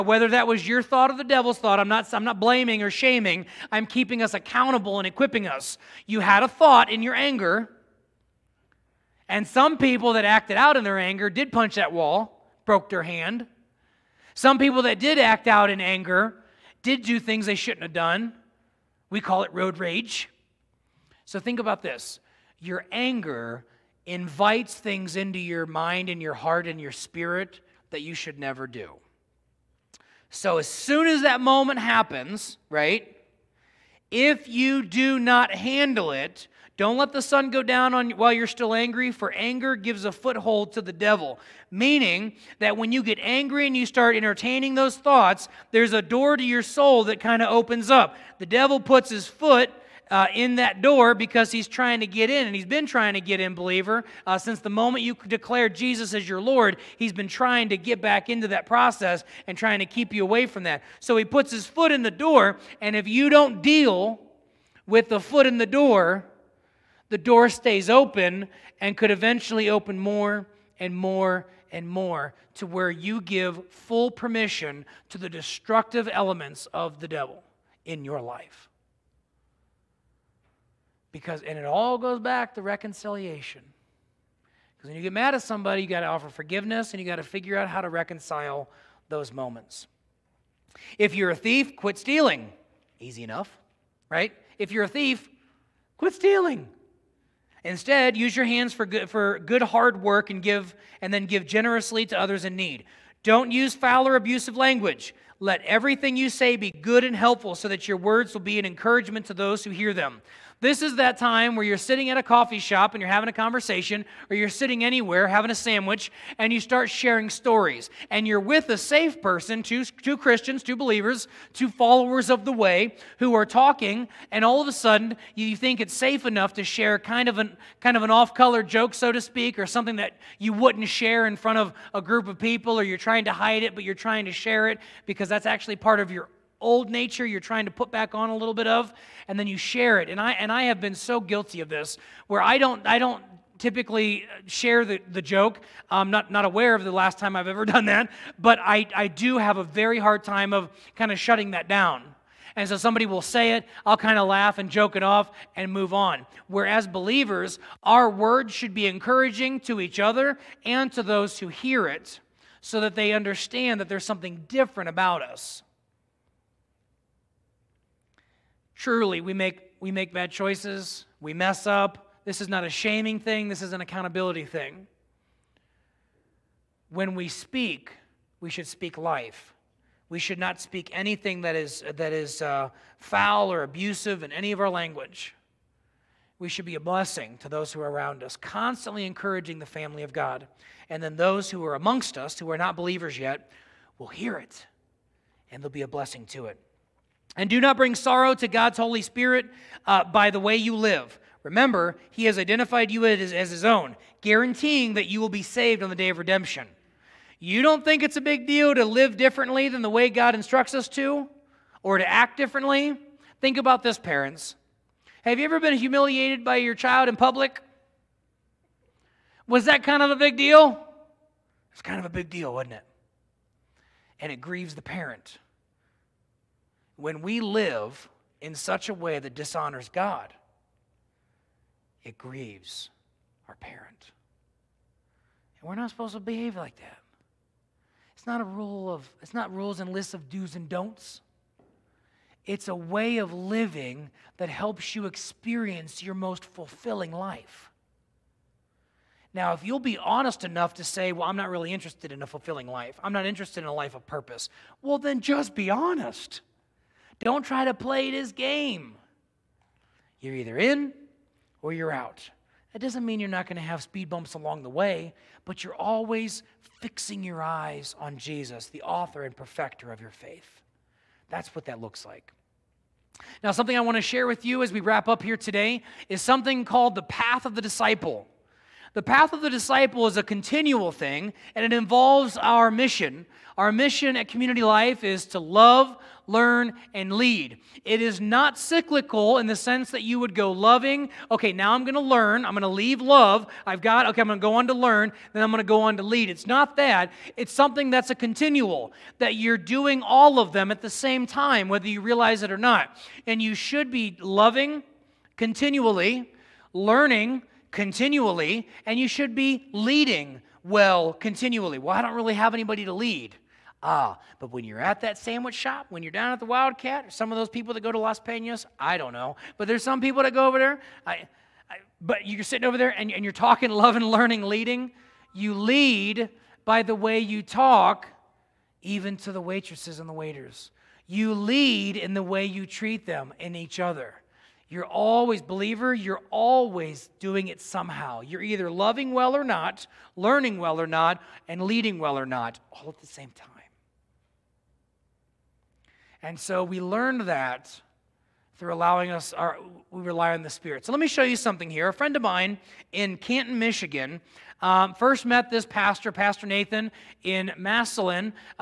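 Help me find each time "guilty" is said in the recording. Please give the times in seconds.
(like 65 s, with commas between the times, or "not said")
141 s.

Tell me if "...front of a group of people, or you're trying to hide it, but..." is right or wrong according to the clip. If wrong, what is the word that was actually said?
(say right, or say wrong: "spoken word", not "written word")
right.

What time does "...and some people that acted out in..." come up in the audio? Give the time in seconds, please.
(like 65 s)
9 s.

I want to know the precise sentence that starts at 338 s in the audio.
You're either loving well or not, learning well or not, and leading well or not, all at the same time.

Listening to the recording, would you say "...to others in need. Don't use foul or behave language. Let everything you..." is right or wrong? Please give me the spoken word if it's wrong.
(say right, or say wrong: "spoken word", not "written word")
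wrong: "abusive", not "behave".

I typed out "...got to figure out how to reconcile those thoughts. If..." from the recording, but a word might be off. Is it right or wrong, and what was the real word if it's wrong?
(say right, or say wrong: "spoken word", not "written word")
wrong: "moments", not "thoughts".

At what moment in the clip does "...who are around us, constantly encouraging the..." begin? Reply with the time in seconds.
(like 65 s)
187 s.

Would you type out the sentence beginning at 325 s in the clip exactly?
You lead by the way you talk, even to the waitresses and the waiters.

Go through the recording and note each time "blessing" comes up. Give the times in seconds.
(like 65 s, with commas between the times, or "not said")
186 s, 195 s.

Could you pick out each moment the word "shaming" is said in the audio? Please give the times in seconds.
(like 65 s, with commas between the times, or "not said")
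2 s, 172 s.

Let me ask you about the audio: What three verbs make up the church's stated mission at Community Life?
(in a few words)
Love, learn, and lead.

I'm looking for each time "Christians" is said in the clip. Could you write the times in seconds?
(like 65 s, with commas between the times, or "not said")
120 s.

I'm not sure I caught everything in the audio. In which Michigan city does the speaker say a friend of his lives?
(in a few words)
Canton.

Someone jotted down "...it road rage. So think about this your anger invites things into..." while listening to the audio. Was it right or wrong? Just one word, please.
right.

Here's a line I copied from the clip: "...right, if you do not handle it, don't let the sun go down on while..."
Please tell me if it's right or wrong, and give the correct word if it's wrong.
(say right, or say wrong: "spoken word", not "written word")
right.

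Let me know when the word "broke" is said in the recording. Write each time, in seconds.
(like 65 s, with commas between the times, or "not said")
12 s.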